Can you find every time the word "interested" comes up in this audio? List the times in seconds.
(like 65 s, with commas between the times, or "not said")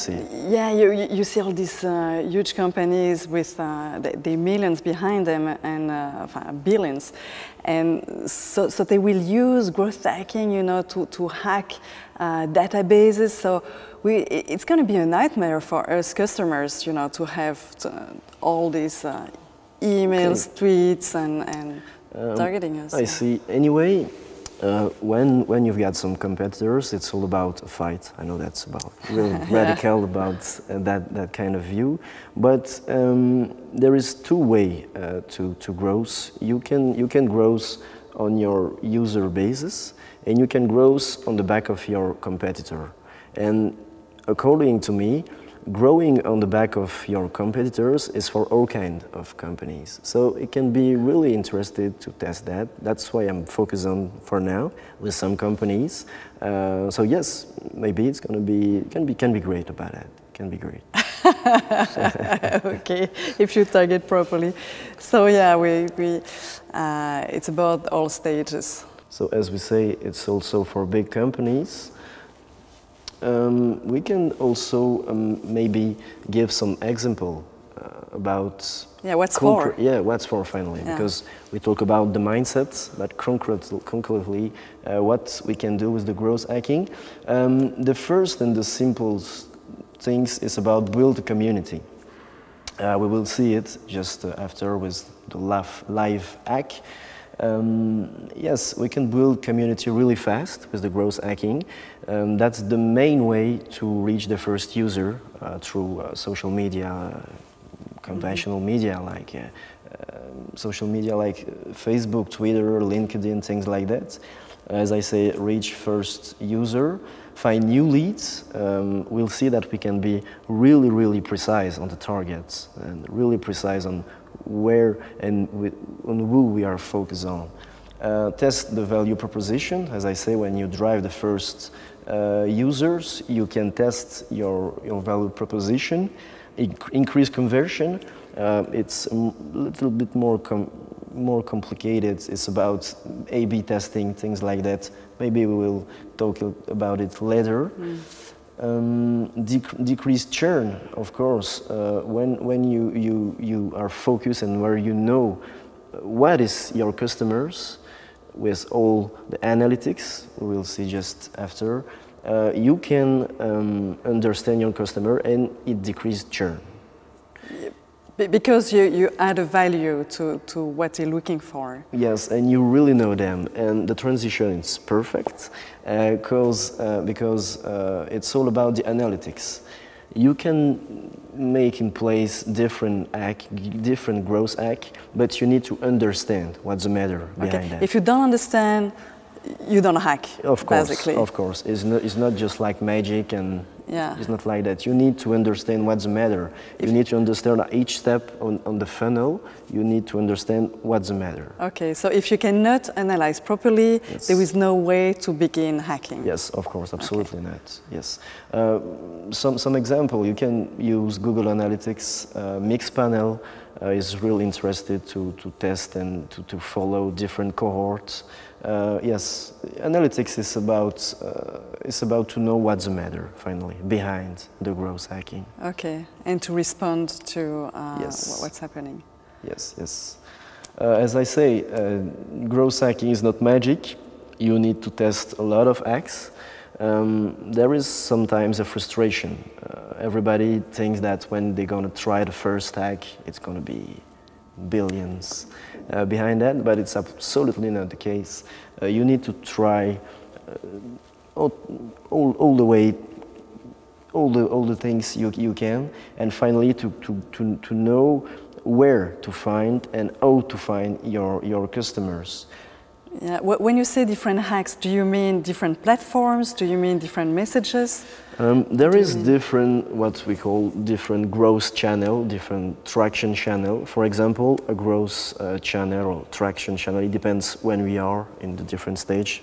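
51 s, 214 s.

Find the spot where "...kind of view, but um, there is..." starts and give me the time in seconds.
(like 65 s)
31 s.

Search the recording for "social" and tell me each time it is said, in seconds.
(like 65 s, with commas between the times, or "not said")
106 s, 110 s.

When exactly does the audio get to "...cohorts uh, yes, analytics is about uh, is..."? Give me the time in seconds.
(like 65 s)
217 s.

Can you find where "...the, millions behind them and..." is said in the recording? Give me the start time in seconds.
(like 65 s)
4 s.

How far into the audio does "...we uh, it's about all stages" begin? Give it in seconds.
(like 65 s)
65 s.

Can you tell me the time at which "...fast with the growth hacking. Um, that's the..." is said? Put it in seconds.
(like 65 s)
100 s.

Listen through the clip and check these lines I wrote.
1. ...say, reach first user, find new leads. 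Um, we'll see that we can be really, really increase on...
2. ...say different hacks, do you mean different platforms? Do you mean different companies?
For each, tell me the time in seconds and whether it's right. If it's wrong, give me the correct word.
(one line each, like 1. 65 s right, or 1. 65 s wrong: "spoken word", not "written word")
1. 115 s wrong: "precise", not "increase"
2. 263 s wrong: "messages", not "companies".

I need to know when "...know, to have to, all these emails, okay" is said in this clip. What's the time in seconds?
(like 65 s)
16 s.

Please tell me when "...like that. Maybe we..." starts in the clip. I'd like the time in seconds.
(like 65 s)
144 s.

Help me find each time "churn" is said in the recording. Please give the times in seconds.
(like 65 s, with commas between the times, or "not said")
150 s, 166 s.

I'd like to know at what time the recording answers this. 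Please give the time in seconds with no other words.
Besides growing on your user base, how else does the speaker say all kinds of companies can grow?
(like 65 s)
45 s.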